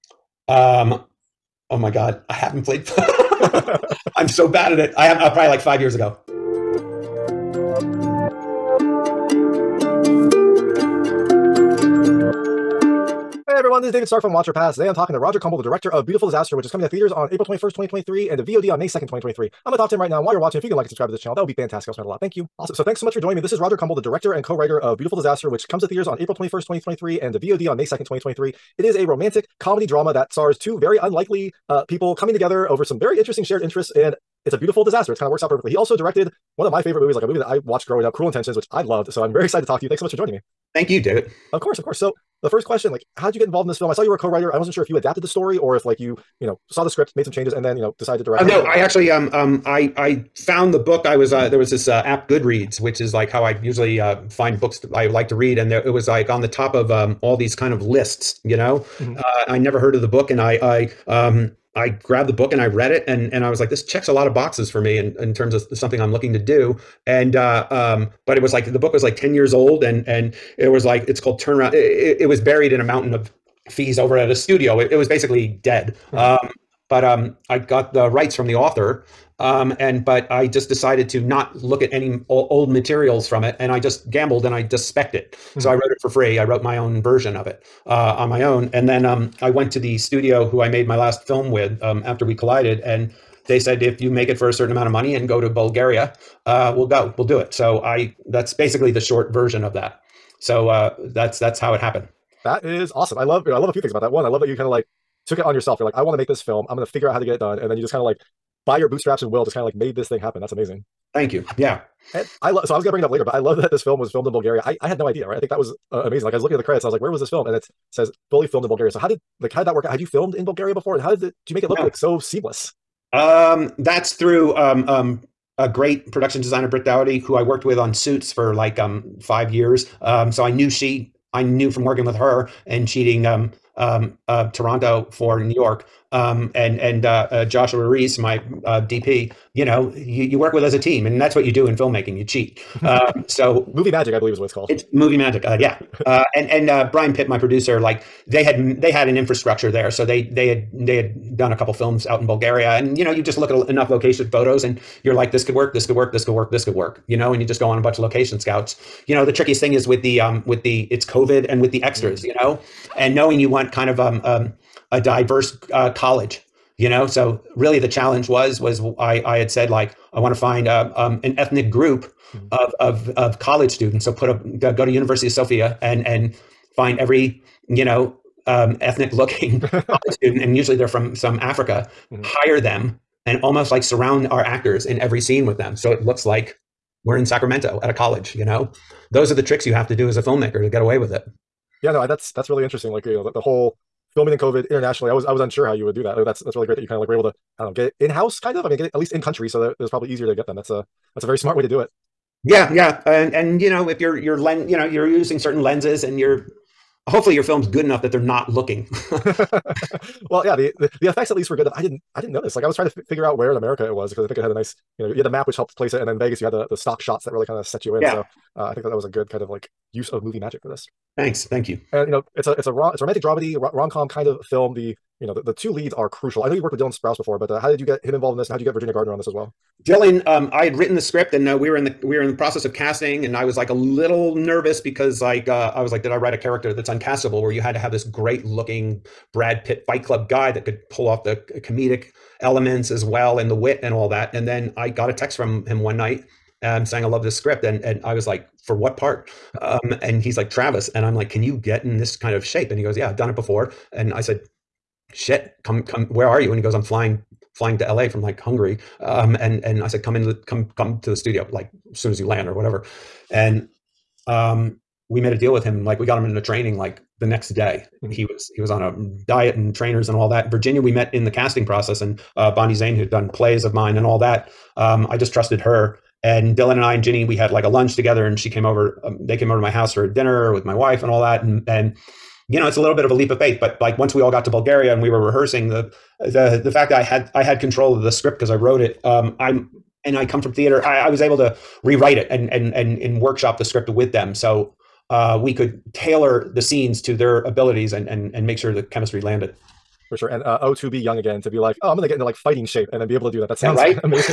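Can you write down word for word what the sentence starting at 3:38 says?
so uh, i think that that was a good kind of like use of movie magic for this Thanks, thank you.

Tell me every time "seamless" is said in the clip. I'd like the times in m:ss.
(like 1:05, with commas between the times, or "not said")
2:02.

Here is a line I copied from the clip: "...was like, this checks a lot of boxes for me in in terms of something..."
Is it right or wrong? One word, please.
right.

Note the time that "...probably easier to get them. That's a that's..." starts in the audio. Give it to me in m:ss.
3:19.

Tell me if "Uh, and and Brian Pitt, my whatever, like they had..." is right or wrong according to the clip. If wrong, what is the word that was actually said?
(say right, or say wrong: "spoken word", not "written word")
wrong: "producer", not "whatever".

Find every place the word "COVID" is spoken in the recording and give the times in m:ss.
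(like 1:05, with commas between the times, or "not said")
2:41, 3:14.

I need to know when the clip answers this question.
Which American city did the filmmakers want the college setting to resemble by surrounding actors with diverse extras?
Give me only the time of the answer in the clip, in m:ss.
3:07.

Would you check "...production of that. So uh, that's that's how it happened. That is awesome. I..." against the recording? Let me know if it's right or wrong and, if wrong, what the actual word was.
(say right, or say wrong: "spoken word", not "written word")
wrong: "version", not "production".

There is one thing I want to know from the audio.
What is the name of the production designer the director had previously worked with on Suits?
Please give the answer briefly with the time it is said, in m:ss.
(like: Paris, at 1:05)
Britt Dowdy, at 2:06.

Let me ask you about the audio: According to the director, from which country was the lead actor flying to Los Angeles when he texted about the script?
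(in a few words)
Hungary.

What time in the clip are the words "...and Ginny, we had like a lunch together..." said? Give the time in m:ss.
4:36.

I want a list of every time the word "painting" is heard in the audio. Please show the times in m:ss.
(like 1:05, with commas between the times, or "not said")
not said.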